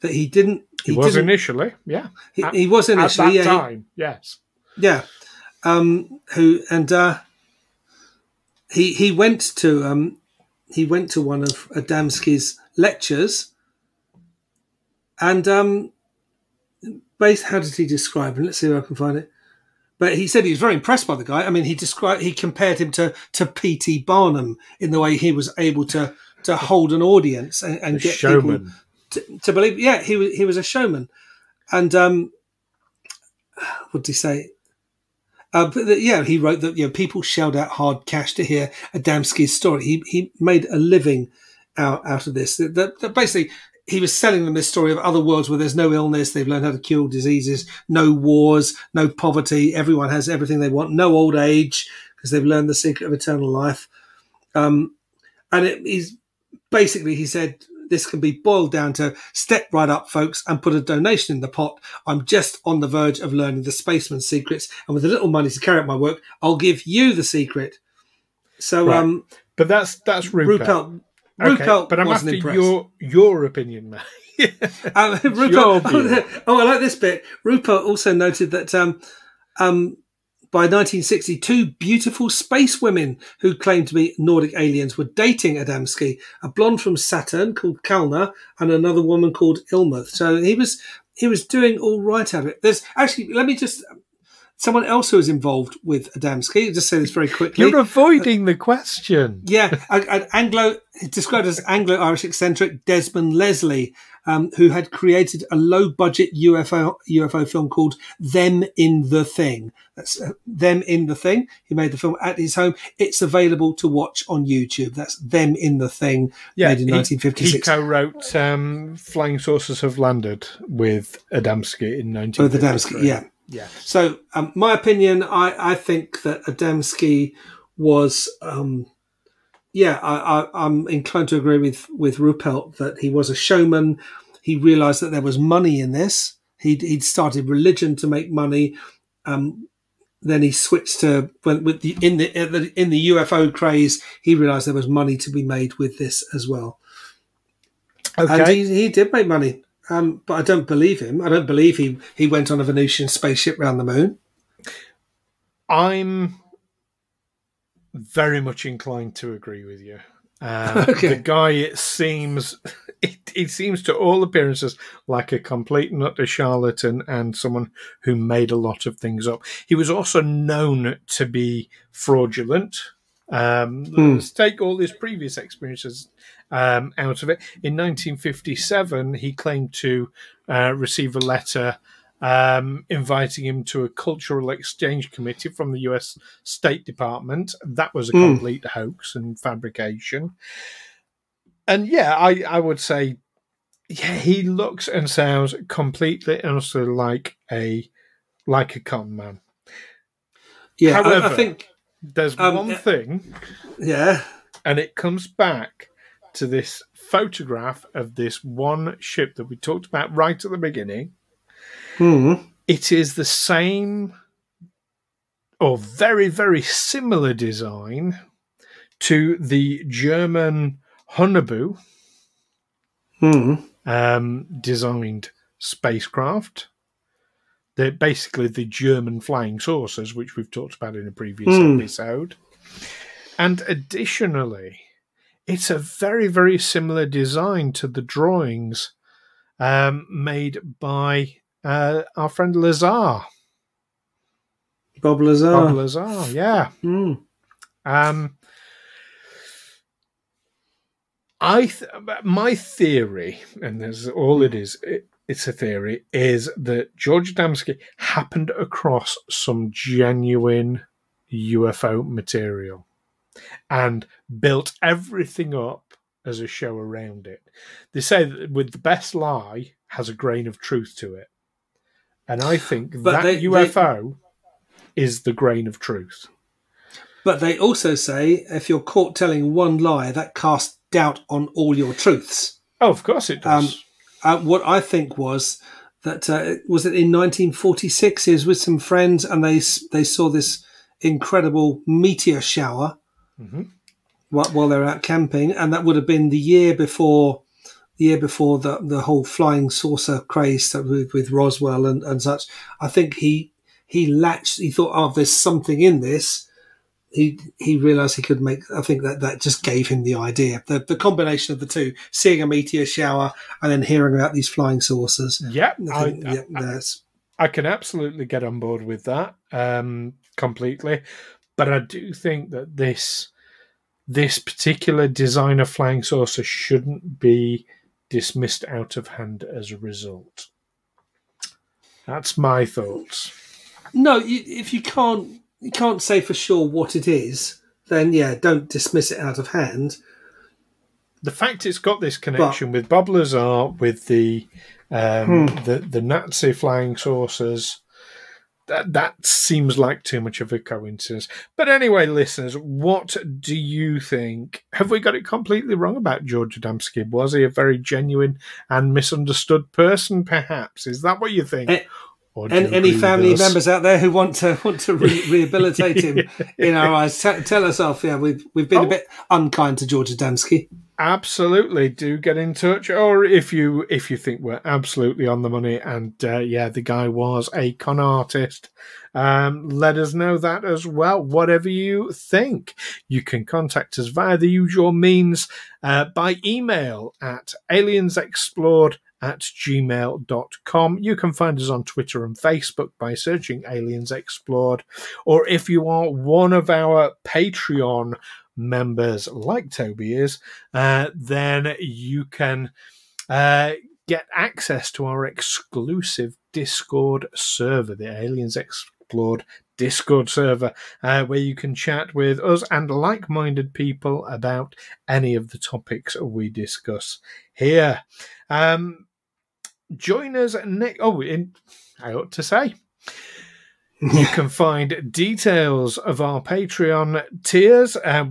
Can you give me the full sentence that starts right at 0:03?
At that yeah, time, he, yes.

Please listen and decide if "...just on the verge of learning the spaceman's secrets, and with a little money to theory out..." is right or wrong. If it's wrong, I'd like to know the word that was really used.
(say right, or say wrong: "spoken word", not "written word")
wrong: "carry", not "theory".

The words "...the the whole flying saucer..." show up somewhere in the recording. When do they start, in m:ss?
4:58.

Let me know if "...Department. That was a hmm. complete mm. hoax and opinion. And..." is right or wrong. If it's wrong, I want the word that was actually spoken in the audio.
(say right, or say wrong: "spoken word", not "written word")
wrong: "fabrication", not "opinion".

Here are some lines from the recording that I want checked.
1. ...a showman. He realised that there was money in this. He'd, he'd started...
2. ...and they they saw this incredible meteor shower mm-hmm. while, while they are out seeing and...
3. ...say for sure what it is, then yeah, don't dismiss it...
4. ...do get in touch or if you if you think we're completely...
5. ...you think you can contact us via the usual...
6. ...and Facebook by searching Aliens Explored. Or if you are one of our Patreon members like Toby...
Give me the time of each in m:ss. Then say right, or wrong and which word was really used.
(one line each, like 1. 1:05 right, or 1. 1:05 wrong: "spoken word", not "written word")
1. 2:13 right
2. 4:49 wrong: "camping", not "seeing"
3. 5:36 right
4. 6:11 wrong: "absolutely", not "completely"
5. 6:21 right
6. 6:32 right.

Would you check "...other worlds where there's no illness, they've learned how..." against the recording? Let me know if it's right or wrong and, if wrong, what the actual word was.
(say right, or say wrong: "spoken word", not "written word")
right.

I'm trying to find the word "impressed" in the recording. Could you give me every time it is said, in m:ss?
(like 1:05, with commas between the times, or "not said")
0:20, 1:12.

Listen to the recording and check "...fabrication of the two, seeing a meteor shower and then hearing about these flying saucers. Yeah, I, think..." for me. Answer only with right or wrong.
wrong.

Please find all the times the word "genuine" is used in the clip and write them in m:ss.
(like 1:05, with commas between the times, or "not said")
4:19, 5:57.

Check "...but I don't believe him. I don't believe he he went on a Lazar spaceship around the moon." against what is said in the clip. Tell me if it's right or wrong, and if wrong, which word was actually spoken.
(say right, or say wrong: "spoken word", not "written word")
wrong: "Venusian", not "Lazar".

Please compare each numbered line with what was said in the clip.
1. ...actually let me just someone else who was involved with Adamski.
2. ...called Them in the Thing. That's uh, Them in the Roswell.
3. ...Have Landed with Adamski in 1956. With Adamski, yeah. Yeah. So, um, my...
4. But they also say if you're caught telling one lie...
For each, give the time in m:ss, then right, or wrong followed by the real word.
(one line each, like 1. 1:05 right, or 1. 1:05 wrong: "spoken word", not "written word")
1. 1:32 right
2. 1:47 wrong: "Thing", not "Roswell"
3. 1:59 right
4. 4:37 right.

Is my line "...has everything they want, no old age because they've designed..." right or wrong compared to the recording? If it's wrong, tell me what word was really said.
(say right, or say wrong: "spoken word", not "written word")
wrong: "learned", not "designed".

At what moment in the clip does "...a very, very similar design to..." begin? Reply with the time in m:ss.
3:55.